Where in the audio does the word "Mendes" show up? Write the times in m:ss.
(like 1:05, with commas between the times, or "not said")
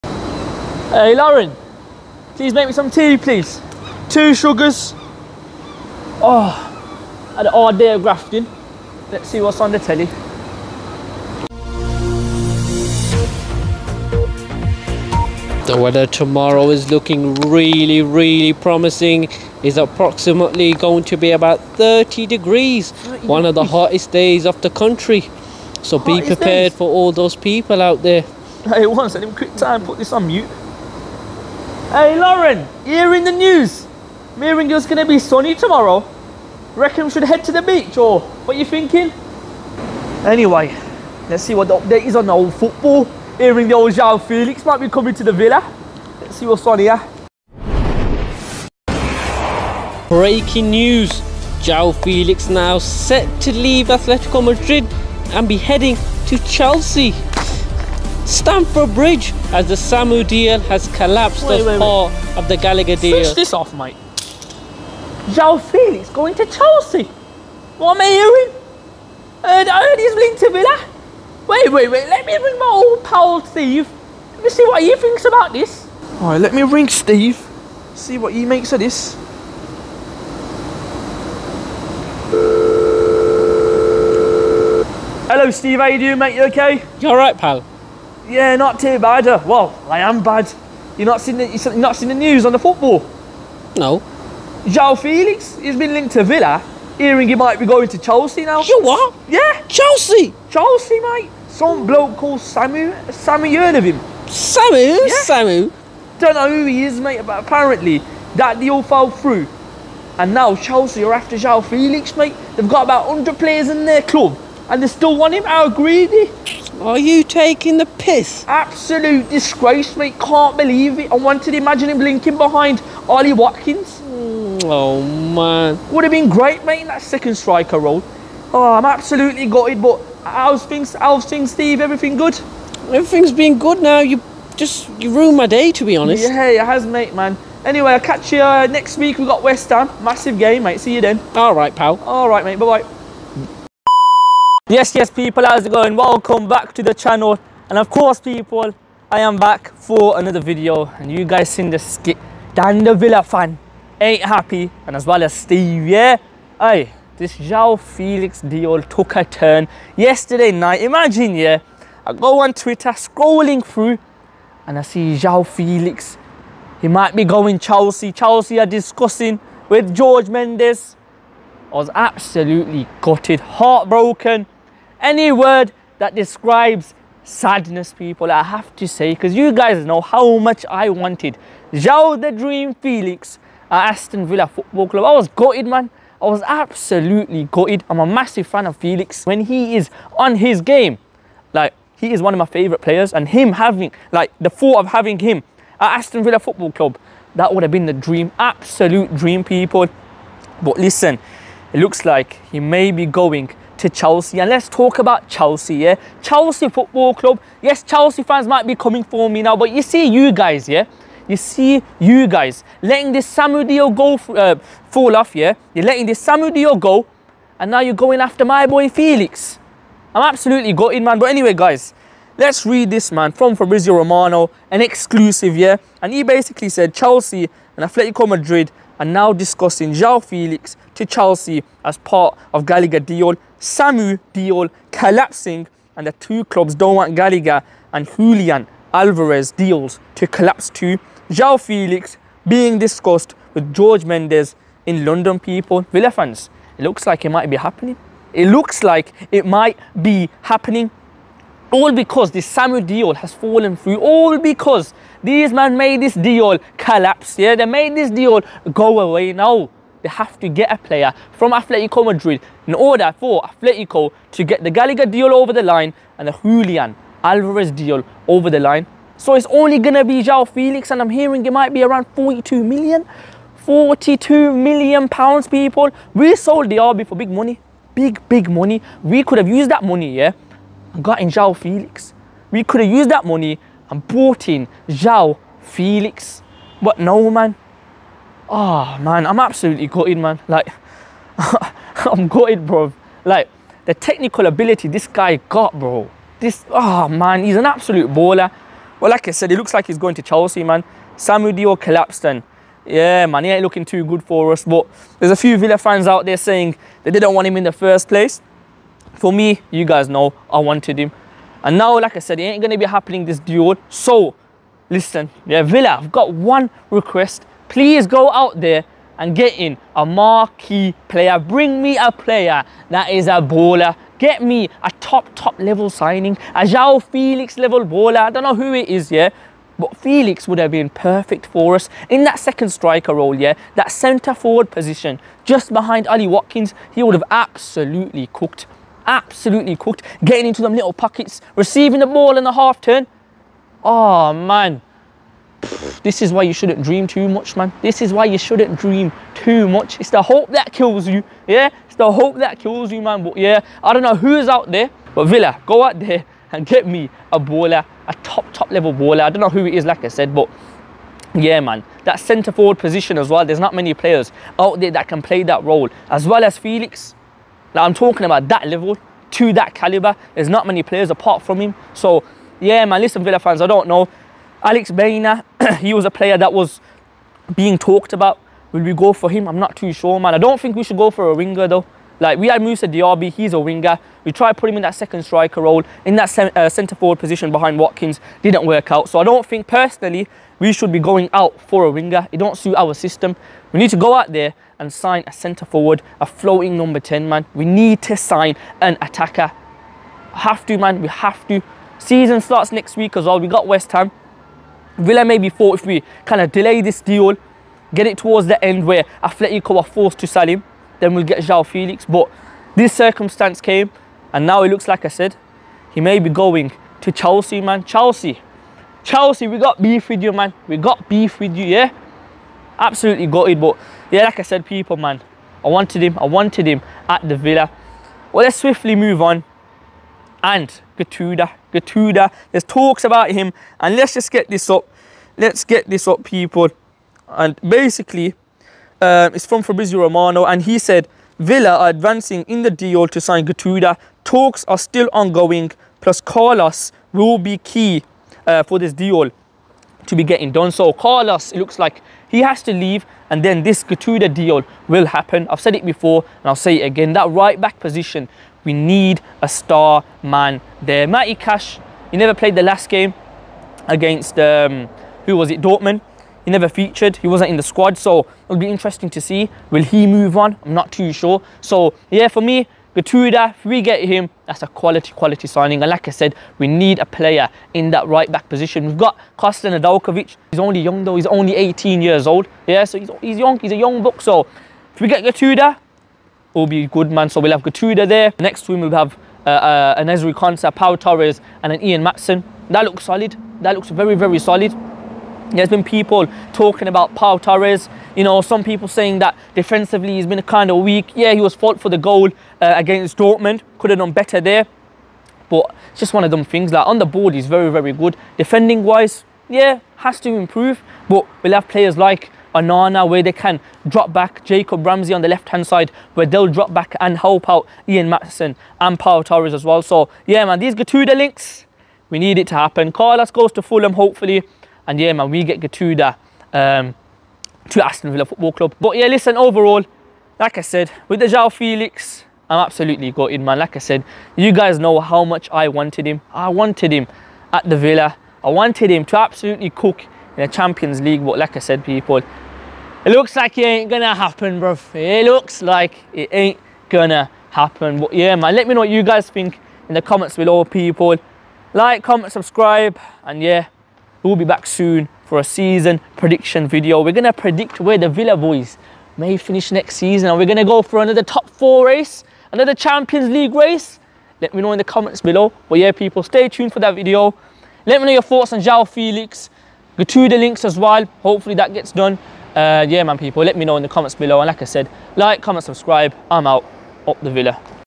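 2:50, 4:04.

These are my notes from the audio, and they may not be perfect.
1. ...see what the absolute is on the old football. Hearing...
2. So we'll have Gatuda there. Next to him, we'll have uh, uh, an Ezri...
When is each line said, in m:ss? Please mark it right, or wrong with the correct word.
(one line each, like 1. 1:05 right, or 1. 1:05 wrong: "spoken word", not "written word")
1. 0:41 wrong: "update", not "absolute"
2. 8:07 right.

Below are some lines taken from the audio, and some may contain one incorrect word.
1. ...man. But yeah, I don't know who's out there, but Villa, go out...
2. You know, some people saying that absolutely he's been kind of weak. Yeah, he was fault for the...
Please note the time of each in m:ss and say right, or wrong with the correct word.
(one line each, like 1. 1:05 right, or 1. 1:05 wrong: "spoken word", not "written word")
1. 5:53 right
2. 8:18 wrong: "defensively", not "absolutely".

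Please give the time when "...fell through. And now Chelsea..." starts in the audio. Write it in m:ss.
1:48.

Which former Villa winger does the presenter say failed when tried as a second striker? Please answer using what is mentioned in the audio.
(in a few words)
Musa Diaby.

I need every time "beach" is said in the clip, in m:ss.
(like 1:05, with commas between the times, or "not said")
0:37.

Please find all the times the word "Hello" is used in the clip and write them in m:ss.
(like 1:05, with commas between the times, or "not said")
1:25.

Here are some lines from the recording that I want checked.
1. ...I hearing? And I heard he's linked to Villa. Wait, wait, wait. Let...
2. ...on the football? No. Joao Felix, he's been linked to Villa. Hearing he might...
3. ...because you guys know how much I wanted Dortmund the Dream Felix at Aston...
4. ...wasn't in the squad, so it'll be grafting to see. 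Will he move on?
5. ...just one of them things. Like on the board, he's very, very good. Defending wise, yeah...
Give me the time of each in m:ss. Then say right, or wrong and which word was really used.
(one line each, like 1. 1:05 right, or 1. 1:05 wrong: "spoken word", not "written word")
1. 1:08 right
2. 1:32 right
3. 2:59 wrong: "João", not "Dortmund"
4. 7:47 wrong: "interesting", not "grafting"
5. 8:25 right.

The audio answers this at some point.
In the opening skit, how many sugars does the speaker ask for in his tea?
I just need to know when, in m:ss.
0:04.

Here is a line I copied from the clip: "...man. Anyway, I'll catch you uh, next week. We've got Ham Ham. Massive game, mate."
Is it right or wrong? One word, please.
wrong.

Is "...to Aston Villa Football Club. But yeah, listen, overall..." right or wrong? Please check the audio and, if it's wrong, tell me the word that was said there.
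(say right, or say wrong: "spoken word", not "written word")
right.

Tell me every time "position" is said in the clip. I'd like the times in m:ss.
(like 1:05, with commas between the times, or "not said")
5:34, 6:02, 6:27, 7:37, 7:58.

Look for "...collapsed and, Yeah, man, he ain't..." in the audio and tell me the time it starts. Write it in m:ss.
5:01.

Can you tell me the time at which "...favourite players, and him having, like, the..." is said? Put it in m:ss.
3:12.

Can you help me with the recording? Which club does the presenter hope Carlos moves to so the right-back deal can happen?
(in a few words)
Fulham.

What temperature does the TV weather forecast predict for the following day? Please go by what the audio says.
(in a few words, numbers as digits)
30 degrees.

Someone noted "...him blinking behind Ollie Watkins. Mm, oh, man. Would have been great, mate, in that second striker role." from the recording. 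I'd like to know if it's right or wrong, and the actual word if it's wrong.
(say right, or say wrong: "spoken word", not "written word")
right.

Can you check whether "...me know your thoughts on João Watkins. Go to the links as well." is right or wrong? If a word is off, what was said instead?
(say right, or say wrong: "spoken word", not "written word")
wrong: "Felix", not "Watkins".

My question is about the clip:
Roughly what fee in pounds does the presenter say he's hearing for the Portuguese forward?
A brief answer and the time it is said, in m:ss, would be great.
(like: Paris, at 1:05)
42 million, at 4:33.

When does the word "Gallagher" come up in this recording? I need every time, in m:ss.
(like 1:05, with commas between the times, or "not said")
1:02, 3:52, 3:57, 4:24.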